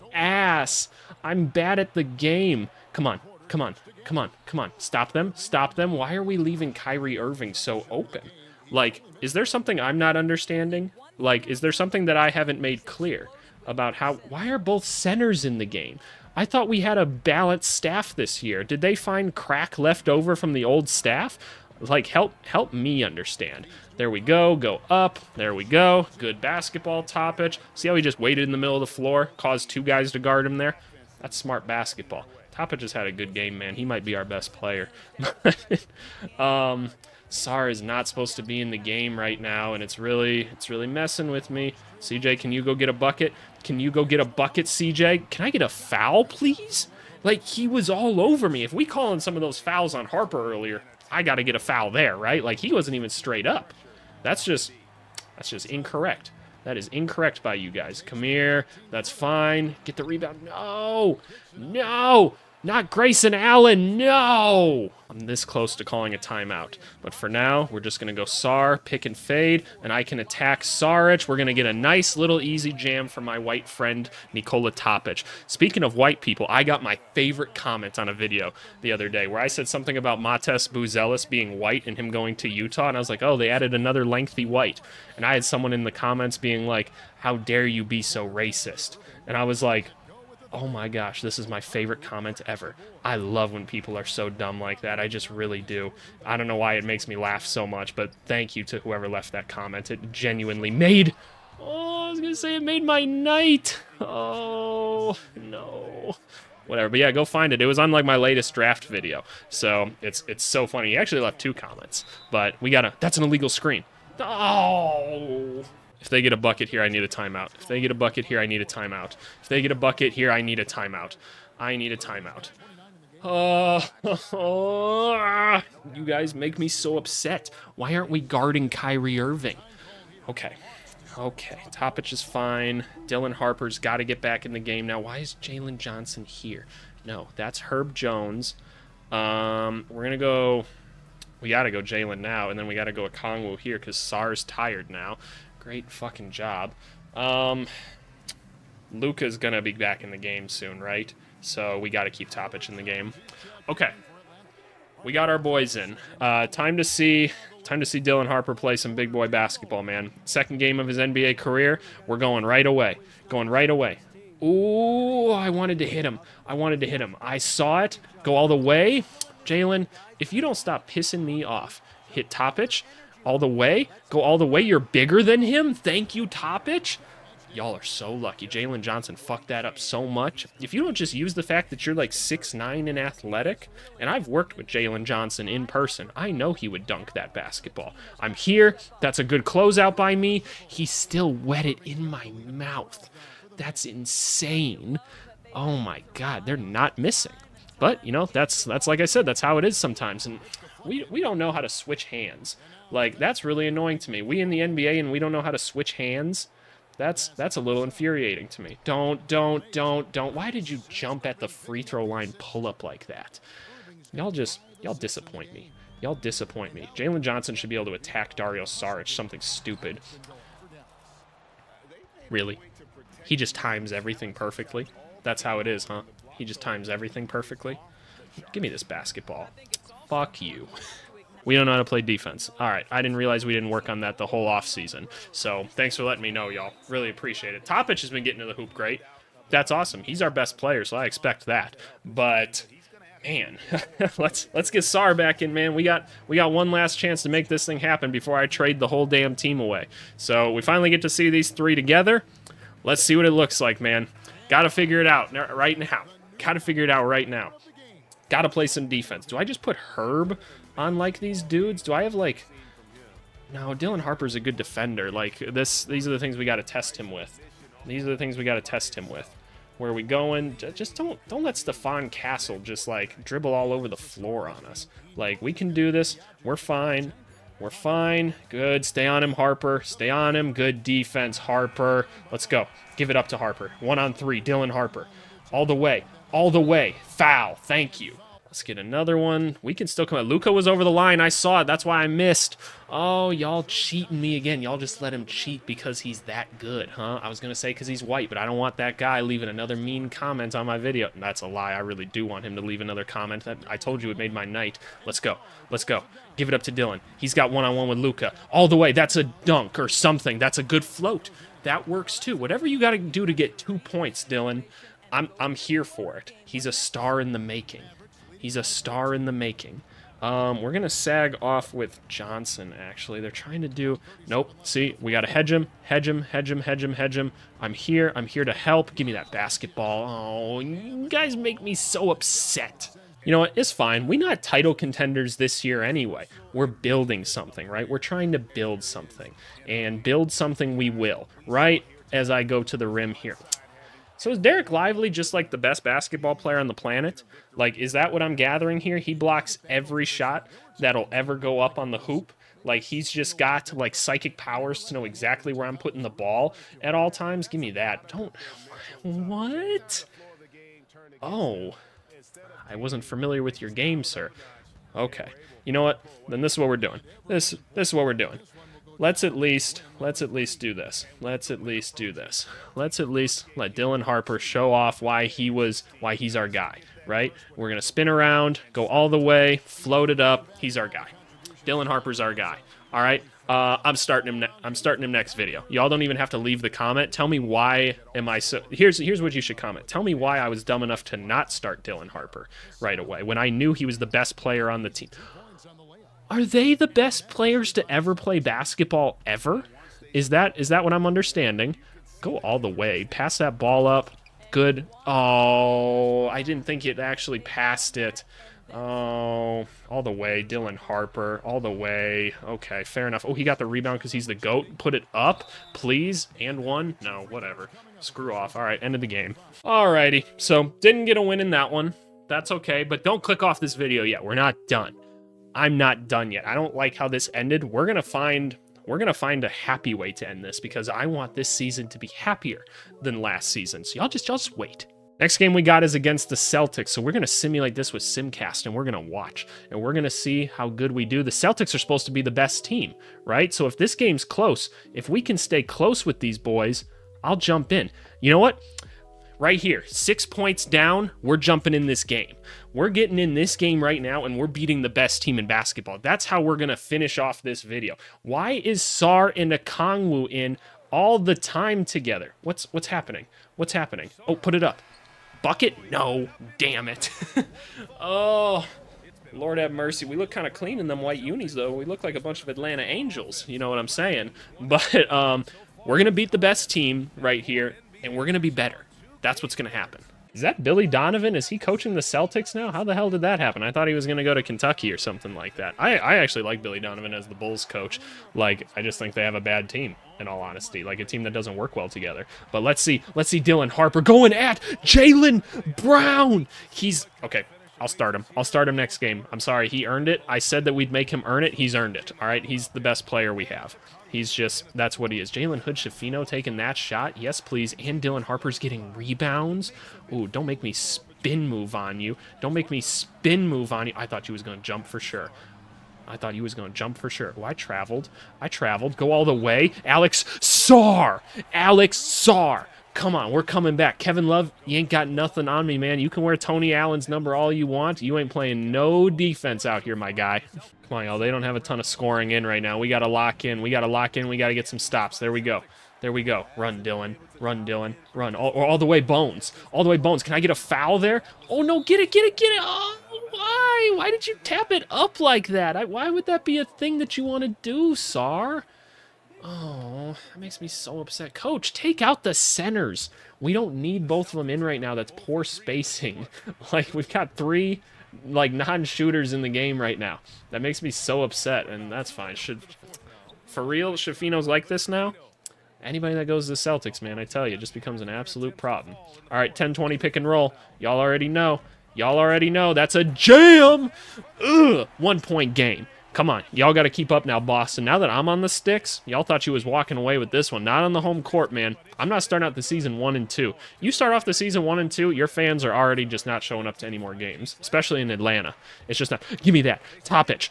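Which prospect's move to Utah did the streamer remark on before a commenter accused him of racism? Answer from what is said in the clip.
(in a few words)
Matas Buzelis.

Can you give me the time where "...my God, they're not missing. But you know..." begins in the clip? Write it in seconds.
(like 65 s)
195 s.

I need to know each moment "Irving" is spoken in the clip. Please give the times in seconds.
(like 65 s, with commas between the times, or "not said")
7 s, 129 s.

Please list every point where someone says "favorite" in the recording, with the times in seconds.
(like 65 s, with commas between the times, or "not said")
77 s, 91 s.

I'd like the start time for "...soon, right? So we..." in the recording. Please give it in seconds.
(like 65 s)
150 s.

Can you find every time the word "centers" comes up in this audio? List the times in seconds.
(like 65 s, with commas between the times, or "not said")
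14 s, 552 s.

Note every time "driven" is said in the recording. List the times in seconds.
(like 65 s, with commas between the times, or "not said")
not said.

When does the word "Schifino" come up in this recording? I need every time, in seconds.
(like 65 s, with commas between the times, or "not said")
505 s, 563 s.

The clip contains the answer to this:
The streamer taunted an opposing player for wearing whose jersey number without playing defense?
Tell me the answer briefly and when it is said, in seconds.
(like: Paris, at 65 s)
Tony Allen, at 526 s.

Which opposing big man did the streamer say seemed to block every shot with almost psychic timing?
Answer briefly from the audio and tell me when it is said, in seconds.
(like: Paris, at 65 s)
Dereck Lively, at 344 s.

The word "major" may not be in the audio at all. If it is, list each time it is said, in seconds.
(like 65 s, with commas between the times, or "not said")
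not said.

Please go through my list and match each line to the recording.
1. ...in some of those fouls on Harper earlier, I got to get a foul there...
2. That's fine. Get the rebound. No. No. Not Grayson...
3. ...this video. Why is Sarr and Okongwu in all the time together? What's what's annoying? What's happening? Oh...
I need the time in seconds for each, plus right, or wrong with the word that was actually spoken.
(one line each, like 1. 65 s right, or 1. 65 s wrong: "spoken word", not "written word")
1. 49 s right
2. 58 s right
3. 457 s wrong: "happening", not "annoying".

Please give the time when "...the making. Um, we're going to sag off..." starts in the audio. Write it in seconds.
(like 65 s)
319 s.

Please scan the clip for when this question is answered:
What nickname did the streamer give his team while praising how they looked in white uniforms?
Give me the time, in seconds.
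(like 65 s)
472 s.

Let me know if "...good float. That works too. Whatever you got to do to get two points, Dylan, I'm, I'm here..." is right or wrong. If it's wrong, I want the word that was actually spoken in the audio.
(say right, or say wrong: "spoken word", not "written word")
right.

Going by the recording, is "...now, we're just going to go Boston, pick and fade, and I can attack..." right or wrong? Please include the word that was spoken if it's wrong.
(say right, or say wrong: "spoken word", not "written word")
wrong: "Sarr", not "Boston".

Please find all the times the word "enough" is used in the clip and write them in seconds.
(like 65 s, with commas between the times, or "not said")
390 s, 413 s.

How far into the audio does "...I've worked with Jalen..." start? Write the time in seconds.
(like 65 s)
184 s.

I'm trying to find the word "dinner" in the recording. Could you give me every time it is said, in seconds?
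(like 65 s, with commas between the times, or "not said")
not said.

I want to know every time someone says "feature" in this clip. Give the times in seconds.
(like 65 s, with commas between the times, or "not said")
not said.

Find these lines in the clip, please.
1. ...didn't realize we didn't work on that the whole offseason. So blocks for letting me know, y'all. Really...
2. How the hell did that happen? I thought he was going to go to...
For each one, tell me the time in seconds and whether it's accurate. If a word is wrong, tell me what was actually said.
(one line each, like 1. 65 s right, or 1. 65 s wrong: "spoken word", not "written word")
1. 233 s wrong: "thanks", not "blocks"
2. 482 s right.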